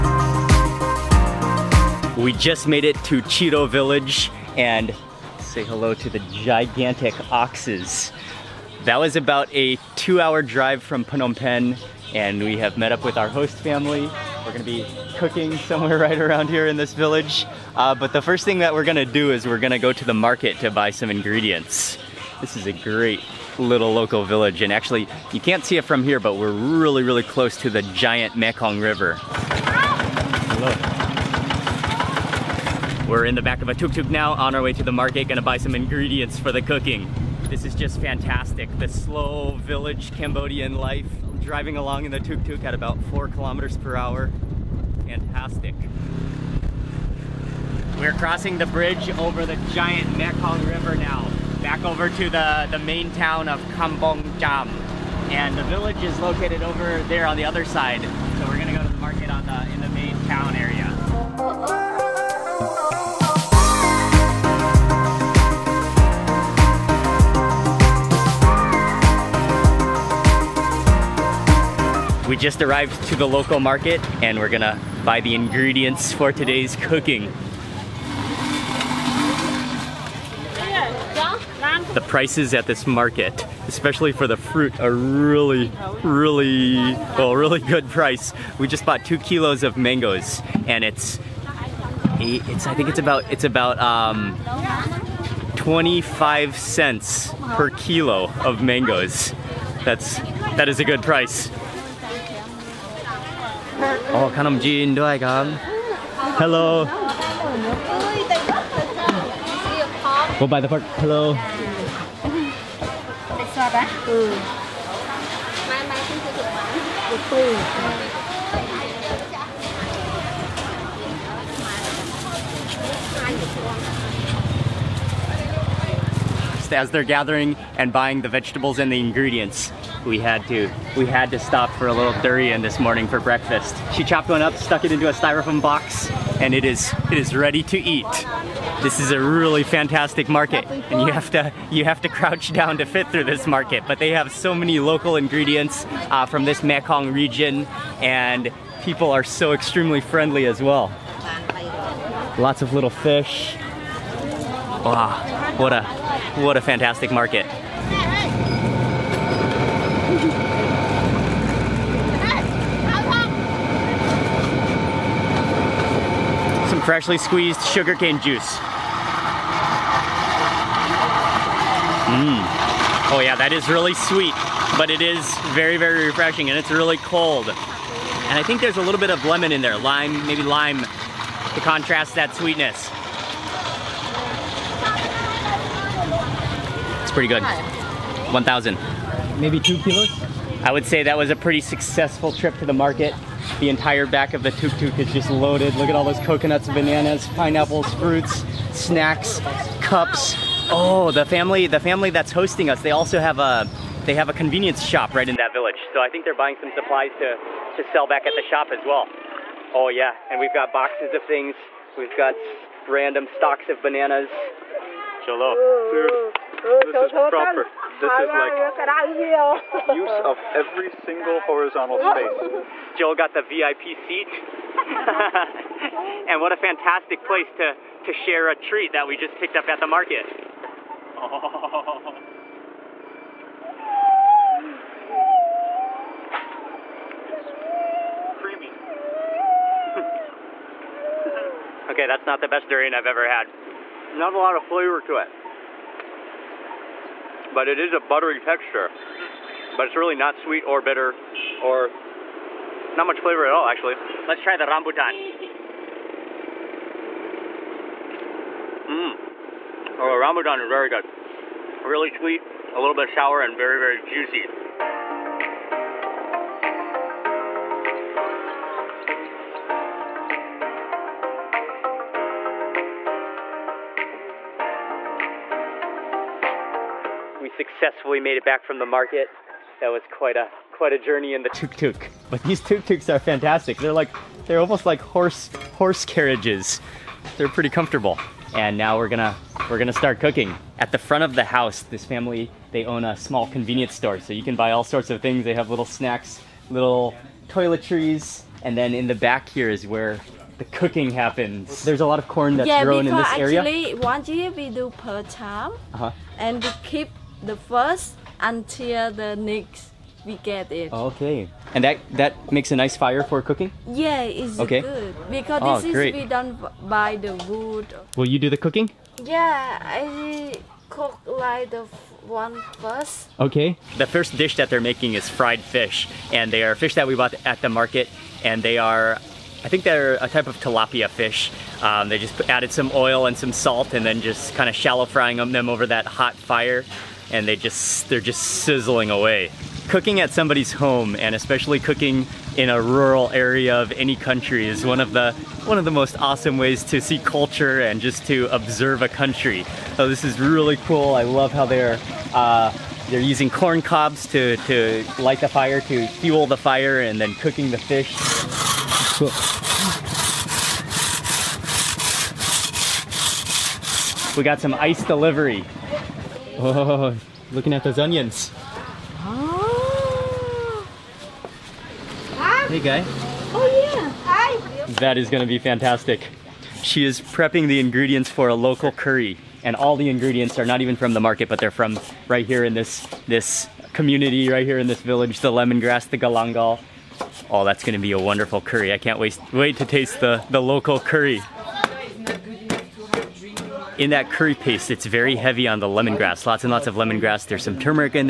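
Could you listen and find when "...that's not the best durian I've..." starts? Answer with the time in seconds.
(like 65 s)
242 s.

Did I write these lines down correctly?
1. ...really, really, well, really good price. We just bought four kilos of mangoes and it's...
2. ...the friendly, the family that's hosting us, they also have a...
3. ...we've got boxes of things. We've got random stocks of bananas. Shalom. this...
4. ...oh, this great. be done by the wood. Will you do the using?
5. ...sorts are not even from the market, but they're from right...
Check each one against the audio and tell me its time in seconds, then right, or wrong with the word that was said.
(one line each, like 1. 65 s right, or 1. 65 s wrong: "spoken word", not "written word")
1. 84 s wrong: "two", not "four"
2. 201 s wrong: "family", not "friendly"
3. 210 s right
4. 315 s wrong: "cooking", not "using"
5. 380 s wrong: "ingredients", not "sorts".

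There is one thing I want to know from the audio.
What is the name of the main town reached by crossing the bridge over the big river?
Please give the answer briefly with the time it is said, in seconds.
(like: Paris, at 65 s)
Kampong Cham, at 53 s.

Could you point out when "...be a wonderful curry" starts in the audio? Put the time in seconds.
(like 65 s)
387 s.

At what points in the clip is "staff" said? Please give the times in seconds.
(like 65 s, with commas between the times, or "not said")
not said.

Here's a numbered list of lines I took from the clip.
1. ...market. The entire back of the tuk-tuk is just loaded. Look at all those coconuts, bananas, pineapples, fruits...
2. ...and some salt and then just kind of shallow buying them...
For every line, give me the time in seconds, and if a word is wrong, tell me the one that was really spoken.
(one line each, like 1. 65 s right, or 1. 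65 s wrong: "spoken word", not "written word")
1. 192 s right
2. 333 s wrong: "frying", not "buying".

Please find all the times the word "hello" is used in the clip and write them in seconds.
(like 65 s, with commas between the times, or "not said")
5 s, 29 s, 106 s, 110 s.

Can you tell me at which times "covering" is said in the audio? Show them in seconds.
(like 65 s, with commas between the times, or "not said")
not said.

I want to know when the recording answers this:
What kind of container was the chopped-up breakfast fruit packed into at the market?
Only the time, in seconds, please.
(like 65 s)
135 s.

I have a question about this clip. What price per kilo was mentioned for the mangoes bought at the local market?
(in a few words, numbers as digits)
25 cents.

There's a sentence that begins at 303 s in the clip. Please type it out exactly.
Yeah, because actually one year we do per time.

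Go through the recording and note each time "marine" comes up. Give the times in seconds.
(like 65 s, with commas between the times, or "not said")
not said.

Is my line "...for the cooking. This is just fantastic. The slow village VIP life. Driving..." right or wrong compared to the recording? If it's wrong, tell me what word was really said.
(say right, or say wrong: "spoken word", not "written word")
wrong: "Cambodian", not "VIP".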